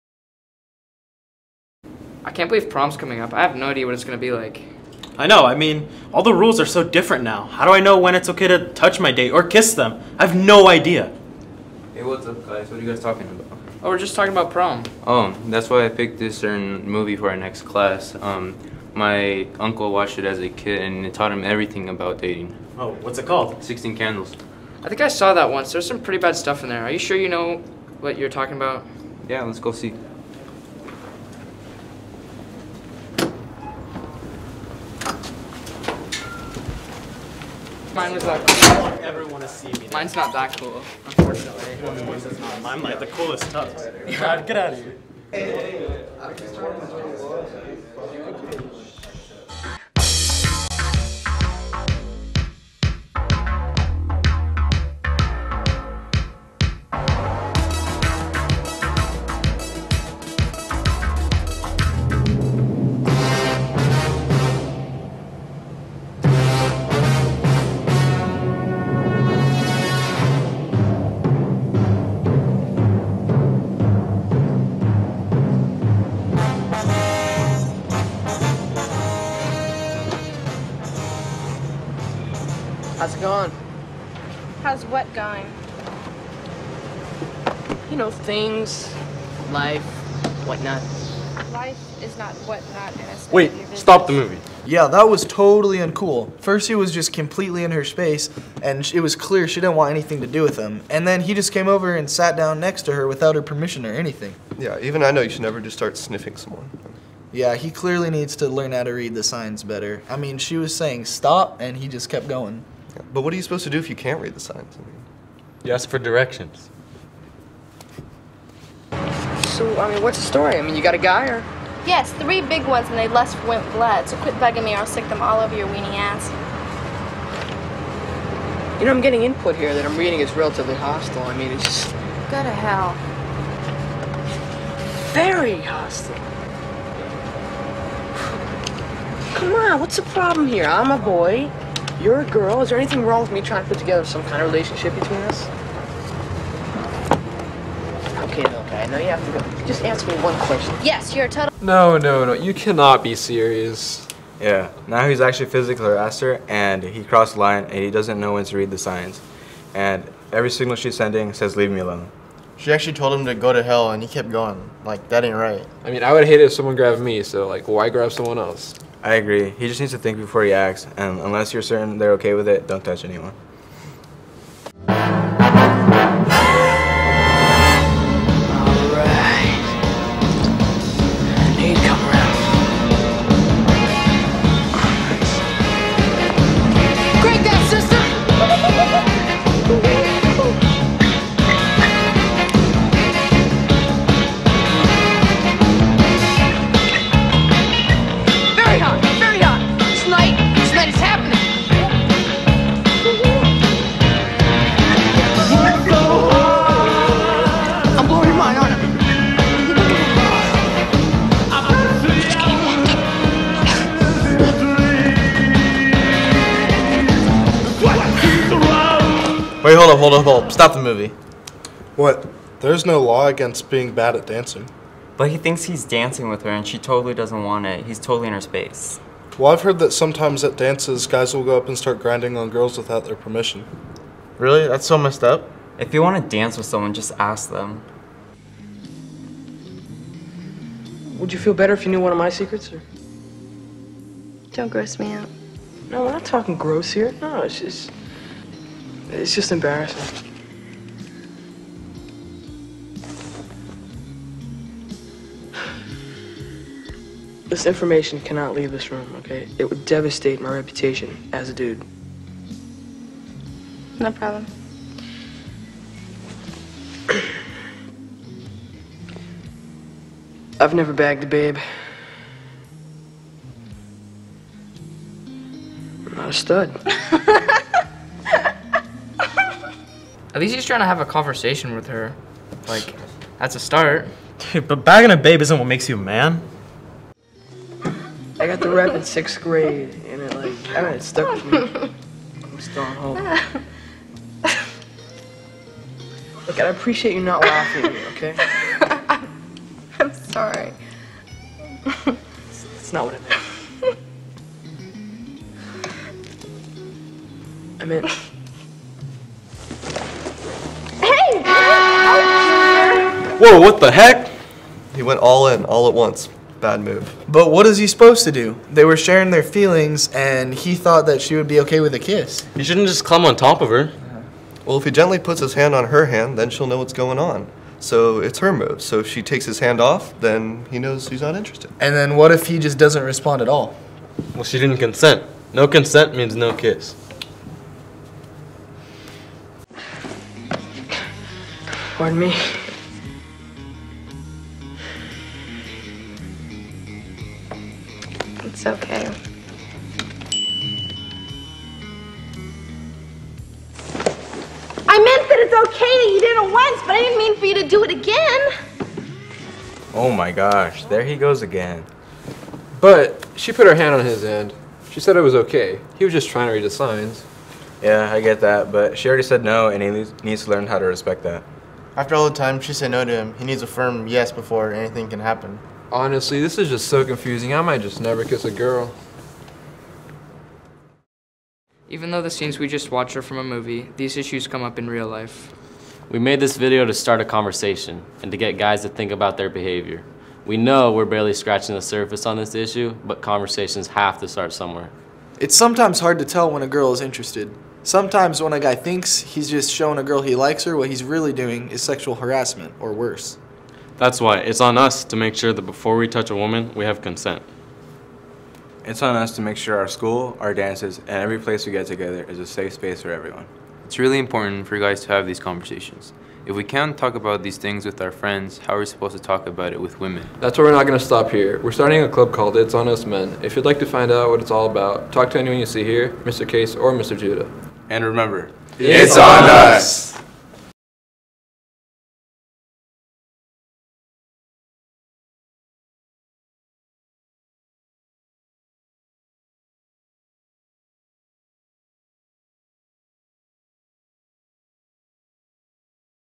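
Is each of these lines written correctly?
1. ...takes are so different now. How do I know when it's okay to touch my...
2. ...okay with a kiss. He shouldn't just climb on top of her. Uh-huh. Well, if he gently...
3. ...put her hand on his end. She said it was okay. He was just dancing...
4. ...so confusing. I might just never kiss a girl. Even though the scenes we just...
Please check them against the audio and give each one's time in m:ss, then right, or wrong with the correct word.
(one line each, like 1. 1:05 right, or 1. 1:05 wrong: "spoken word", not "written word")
1. 0:06 wrong: "rules", not "takes"
2. 5:21 right
3. 6:03 wrong: "trying", not "dancing"
4. 6:16 right.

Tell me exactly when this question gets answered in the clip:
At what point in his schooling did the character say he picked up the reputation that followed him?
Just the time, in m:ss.
4:49.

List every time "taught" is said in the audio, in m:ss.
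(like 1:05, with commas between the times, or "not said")
0:21.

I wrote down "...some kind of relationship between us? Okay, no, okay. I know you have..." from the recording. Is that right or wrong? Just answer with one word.
right.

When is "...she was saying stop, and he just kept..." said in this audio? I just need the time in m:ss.
1:50.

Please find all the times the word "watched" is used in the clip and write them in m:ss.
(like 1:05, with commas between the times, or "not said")
0:19, 6:22.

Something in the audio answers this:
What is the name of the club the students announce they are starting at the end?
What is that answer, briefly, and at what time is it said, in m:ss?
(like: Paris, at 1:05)
It's On Us Men, at 7:02.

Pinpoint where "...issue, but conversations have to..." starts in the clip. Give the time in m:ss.
6:32.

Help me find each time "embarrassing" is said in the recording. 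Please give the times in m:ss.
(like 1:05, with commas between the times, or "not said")
4:09.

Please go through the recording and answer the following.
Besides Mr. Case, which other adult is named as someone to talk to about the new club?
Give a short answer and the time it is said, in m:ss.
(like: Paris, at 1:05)
Mr. Judah, at 7:06.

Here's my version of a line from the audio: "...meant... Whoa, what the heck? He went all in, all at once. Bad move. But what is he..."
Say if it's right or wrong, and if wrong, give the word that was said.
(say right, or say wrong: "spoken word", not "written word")
right.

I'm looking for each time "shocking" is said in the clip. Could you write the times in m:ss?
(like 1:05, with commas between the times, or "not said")
not said.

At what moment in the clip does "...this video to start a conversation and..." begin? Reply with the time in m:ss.
6:26.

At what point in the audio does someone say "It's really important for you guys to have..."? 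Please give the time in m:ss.
6:53.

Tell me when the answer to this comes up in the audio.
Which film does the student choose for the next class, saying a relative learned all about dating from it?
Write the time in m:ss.
0:23.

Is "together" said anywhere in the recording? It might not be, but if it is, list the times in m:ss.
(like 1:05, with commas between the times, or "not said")
2:23, 6:51.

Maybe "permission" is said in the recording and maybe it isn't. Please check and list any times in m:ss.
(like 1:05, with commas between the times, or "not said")
1:43, 3:53.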